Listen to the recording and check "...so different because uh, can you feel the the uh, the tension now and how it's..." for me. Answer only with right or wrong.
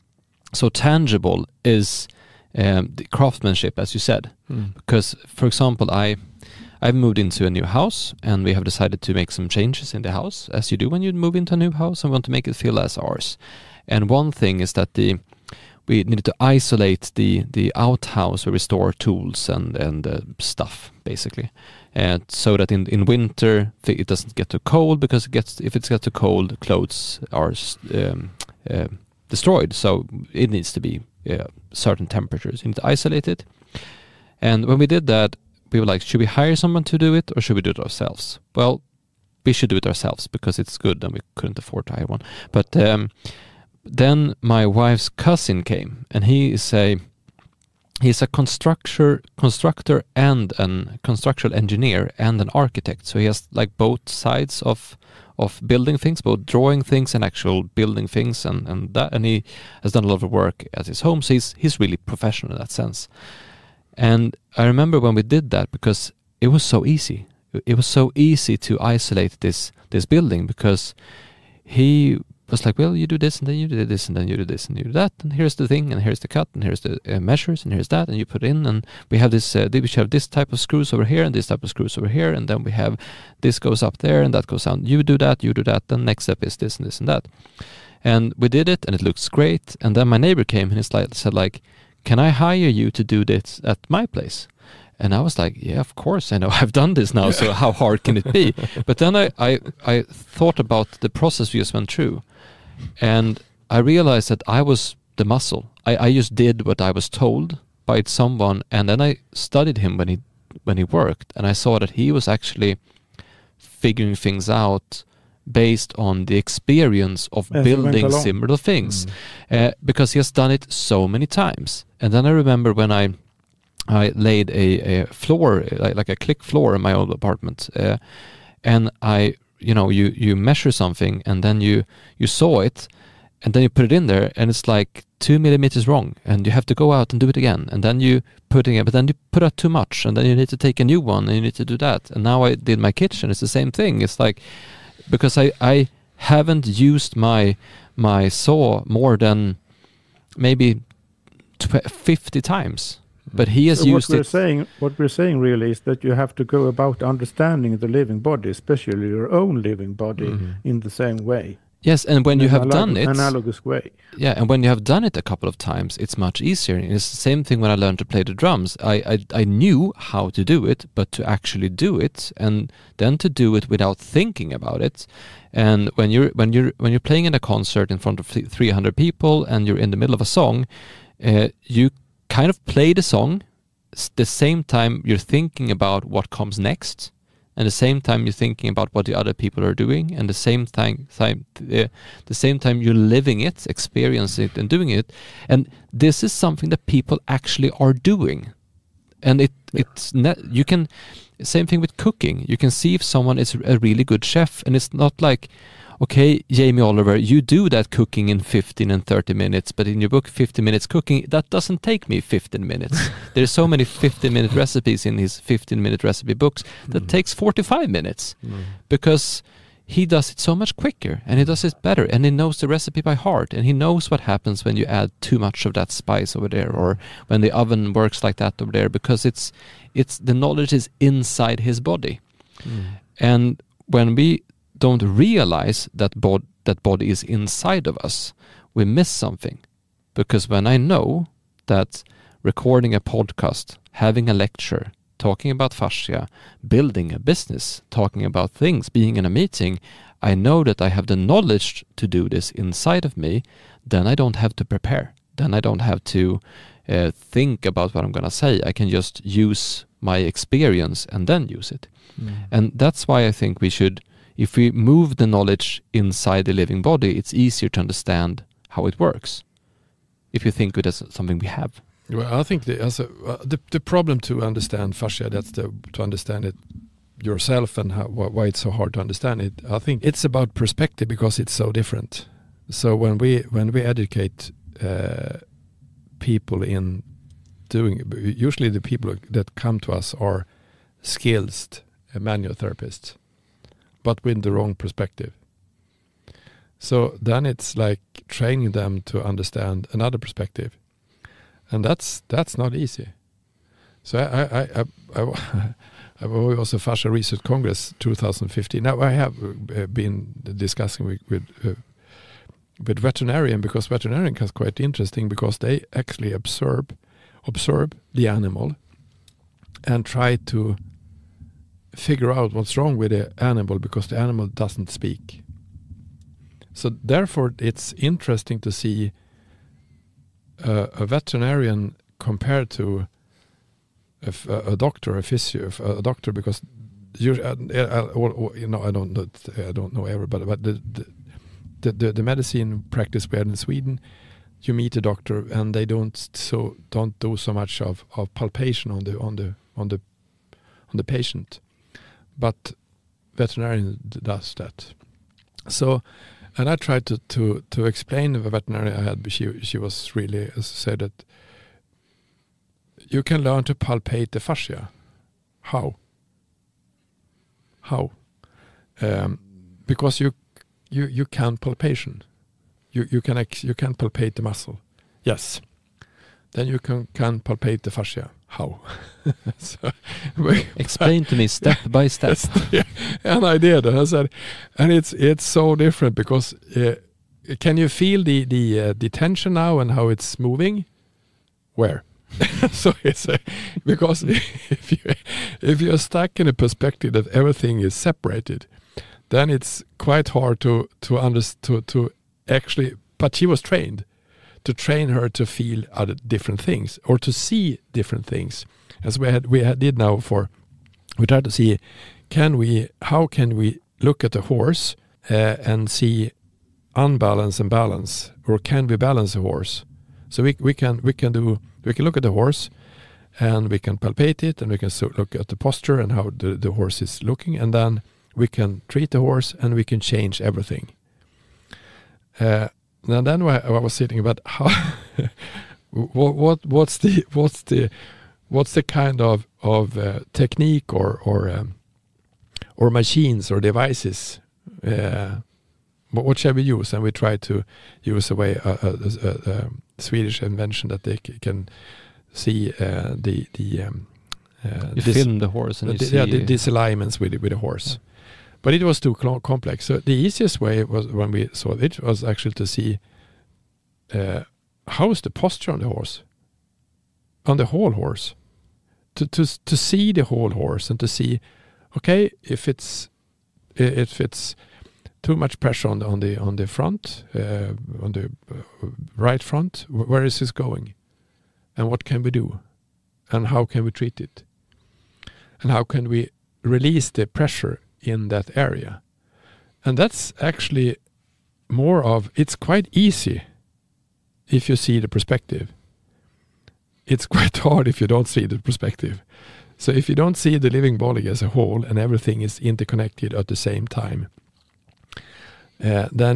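right.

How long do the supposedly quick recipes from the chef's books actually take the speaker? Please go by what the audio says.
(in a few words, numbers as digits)
45 minutes.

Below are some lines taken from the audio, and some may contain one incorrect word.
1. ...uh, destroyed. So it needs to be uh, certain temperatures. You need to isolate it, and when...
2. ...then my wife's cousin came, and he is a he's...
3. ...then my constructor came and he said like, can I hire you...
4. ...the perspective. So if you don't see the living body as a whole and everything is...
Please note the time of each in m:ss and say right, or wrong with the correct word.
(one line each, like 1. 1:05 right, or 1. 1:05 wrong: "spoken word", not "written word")
1. 0:28 right
2. 0:43 right
3. 1:29 wrong: "neighbor", not "constructor"
4. 8:18 right.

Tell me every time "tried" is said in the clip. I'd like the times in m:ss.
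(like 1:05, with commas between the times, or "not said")
5:56, 6:51.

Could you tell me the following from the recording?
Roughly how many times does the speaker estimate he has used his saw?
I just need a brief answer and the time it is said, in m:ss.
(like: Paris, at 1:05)
50, at 2:31.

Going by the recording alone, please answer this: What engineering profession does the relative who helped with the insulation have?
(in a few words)
Construction engineer.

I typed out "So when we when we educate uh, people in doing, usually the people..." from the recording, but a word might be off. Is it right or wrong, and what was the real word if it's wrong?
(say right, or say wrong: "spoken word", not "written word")
right.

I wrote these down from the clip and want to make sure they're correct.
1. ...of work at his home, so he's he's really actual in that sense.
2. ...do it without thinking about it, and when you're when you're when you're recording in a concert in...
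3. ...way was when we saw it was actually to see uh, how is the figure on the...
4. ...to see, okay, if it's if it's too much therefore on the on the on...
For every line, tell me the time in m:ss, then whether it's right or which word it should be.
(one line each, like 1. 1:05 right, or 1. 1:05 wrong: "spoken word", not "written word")
1. 1:00 wrong: "professional", not "actual"
2. 2:53 wrong: "playing", not "recording"
3. 7:40 wrong: "posture", not "figure"
4. 7:50 wrong: "pressure", not "therefore".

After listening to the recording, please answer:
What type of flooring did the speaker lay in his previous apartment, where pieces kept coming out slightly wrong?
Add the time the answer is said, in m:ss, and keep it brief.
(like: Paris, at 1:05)
Click floor, at 2:06.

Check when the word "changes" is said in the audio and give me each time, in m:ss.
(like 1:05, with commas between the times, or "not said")
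0:09, 7:09.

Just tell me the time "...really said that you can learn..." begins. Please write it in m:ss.
6:00.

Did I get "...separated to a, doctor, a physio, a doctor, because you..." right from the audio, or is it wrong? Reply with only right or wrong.
wrong.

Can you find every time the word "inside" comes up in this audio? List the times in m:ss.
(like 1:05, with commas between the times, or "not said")
3:50, 3:57, 4:12, 4:25.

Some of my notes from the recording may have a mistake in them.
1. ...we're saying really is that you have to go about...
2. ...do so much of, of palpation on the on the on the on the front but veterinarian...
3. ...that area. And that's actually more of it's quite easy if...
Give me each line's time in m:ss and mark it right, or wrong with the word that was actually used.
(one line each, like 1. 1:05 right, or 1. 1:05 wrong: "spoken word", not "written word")
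1. 2:34 right
2. 5:47 wrong: "patient", not "front"
3. 8:08 right.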